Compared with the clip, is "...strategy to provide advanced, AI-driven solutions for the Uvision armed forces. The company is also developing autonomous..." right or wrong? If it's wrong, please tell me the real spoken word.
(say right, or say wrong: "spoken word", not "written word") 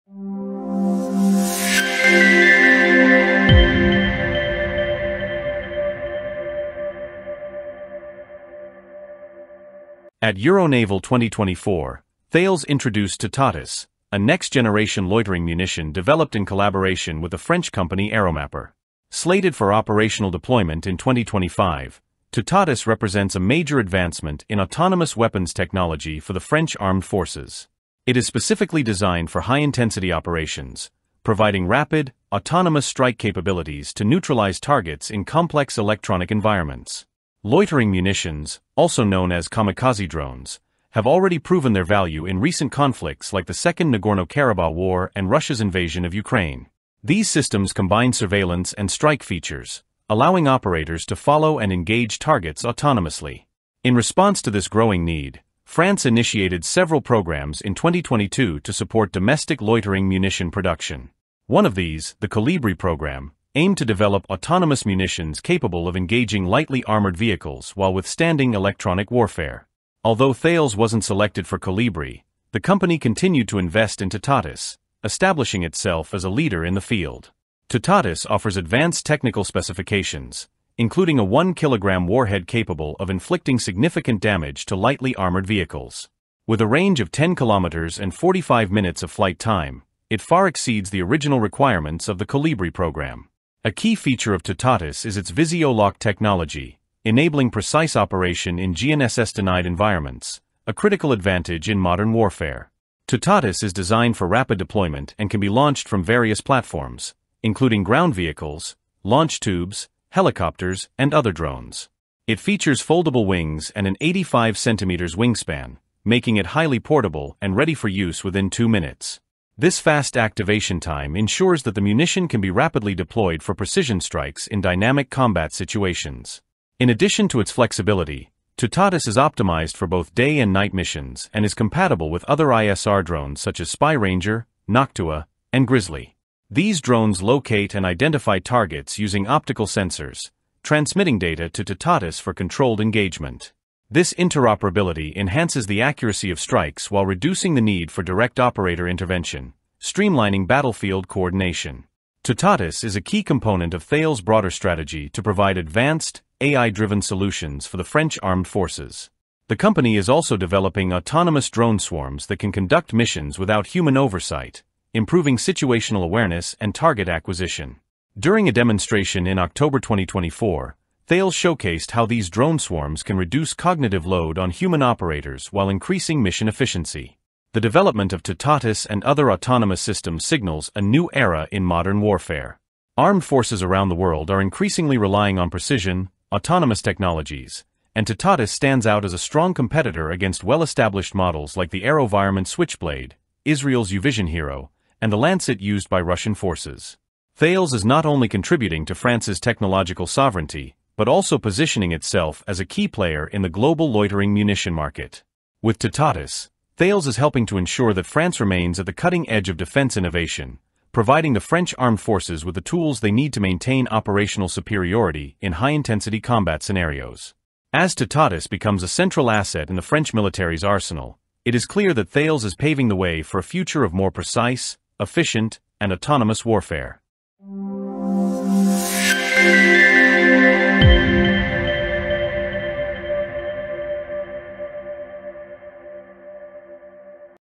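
wrong: "French", not "Uvision".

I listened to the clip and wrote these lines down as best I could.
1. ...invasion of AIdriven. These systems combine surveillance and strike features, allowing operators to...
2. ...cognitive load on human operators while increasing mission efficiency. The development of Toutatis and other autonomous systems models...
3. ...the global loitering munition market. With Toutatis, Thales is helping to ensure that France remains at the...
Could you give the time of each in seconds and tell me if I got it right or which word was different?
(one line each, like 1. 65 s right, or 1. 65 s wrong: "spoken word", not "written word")
1. 45 s wrong: "Ukraine", not "AIdriven"
2. 173 s wrong: "signals", not "models"
3. 203 s right.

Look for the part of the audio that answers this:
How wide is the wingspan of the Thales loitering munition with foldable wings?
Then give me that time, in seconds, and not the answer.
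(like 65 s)
114 s.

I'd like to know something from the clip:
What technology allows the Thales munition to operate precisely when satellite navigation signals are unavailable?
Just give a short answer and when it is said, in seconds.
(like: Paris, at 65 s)
VisioLoc, at 95 s.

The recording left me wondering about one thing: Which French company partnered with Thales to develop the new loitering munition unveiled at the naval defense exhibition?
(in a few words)
Aeromapper.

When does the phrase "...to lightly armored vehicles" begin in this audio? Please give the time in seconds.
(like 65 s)
84 s.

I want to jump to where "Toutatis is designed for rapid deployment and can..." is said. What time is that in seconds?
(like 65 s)
103 s.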